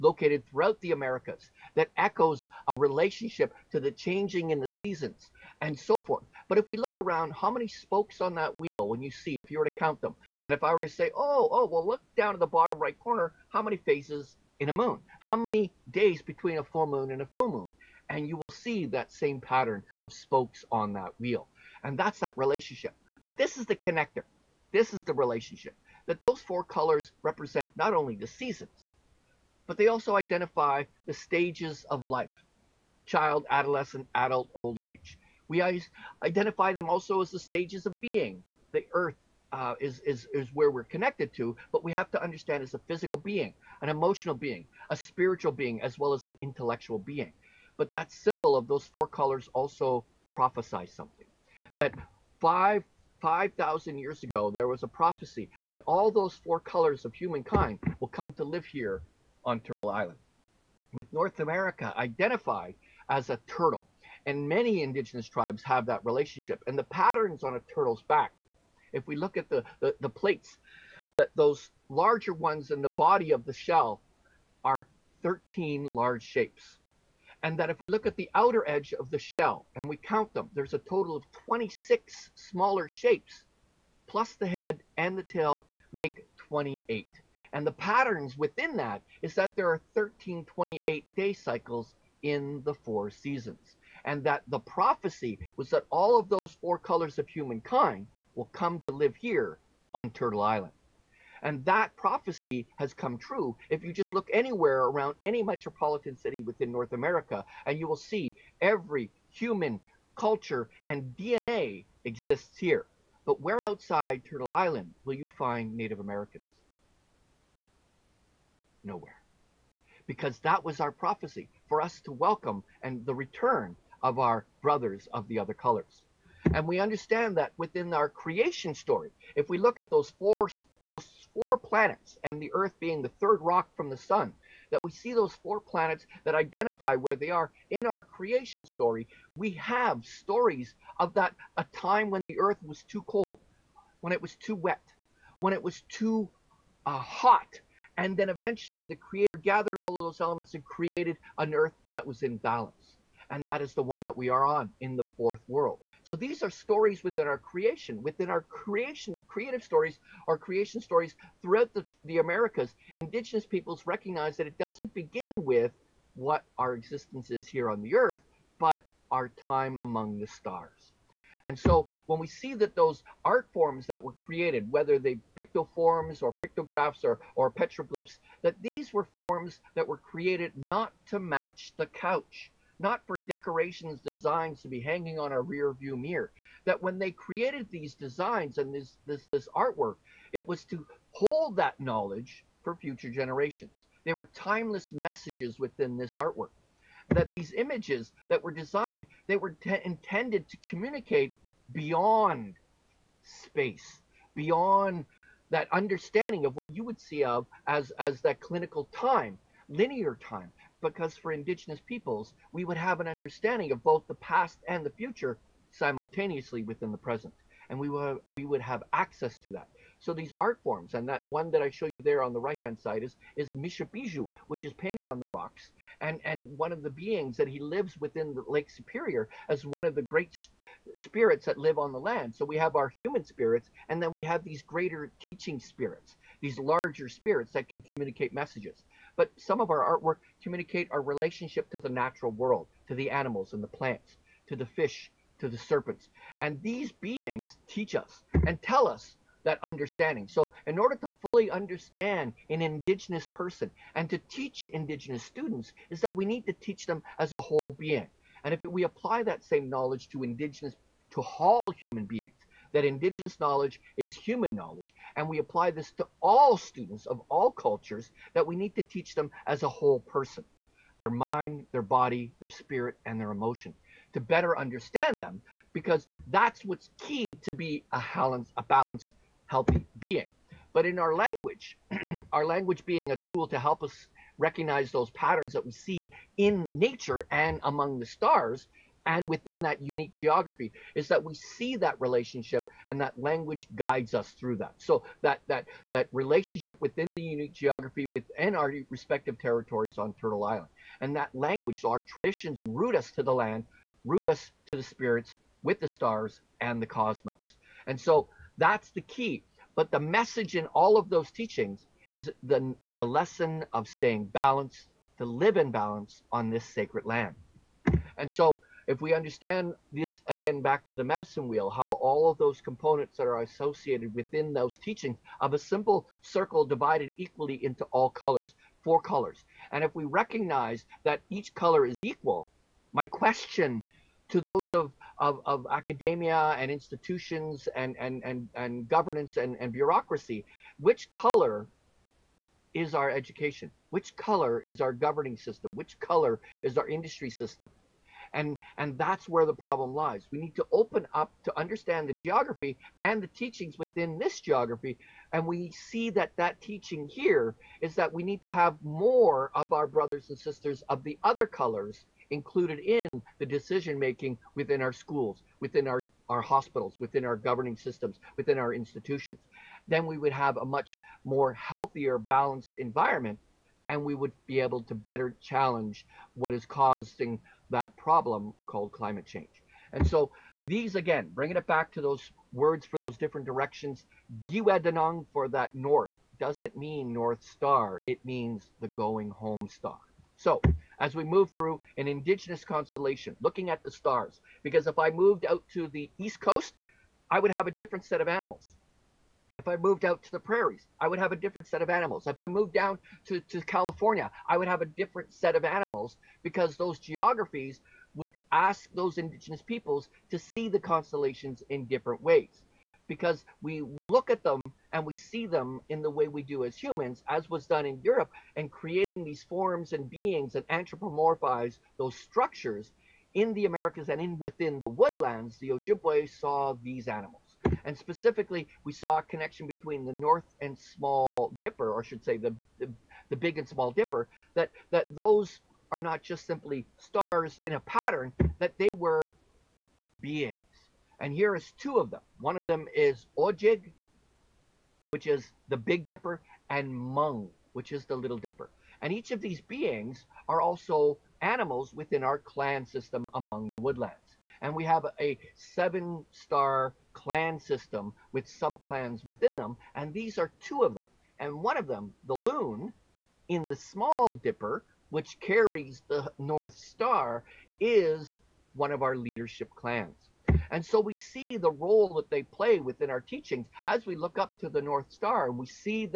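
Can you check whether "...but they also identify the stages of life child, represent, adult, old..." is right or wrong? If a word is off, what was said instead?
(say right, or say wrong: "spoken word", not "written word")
wrong: "adolescent", not "represent".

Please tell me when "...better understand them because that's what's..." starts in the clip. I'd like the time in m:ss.
4:34.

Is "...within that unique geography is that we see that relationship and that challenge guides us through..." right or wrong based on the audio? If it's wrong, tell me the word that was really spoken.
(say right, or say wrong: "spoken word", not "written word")
wrong: "language", not "challenge".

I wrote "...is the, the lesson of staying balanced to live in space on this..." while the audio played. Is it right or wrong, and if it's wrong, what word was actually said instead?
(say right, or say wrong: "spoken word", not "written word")
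wrong: "balance", not "space".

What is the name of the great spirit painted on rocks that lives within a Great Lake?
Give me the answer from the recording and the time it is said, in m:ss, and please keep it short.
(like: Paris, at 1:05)
Mishabiju, at 3:43.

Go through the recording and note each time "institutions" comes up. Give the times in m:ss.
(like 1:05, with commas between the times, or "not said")
5:36, 6:08.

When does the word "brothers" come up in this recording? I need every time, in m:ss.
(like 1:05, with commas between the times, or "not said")
2:04, 5:59.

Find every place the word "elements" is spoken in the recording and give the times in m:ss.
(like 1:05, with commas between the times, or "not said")
2:30.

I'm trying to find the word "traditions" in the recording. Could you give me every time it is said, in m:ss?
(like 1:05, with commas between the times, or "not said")
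5:02.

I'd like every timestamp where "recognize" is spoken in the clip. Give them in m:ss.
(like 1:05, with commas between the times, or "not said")
2:43, 4:44, 5:30.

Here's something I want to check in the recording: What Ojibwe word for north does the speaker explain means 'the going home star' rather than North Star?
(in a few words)
Giwadanong.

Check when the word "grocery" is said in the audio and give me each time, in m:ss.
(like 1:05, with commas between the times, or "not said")
not said.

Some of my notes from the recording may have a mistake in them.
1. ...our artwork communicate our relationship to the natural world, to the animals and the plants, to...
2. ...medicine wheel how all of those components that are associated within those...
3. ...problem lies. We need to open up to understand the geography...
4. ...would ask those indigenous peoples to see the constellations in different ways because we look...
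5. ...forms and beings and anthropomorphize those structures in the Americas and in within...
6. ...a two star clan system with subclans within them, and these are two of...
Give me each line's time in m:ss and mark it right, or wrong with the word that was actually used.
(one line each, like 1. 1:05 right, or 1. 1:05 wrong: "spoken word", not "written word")
1. 3:59 right
2. 5:21 right
3. 5:49 right
4. 6:48 right
5. 6:59 right
6. 7:35 wrong: "seven", not "two".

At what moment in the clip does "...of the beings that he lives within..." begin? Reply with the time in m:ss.
3:46.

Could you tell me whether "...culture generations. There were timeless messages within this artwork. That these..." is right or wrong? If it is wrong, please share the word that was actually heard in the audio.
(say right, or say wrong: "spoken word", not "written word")
wrong: "future", not "culture".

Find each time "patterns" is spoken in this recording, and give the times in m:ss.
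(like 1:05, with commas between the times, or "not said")
0:19, 1:06, 1:27, 4:45, 7:17.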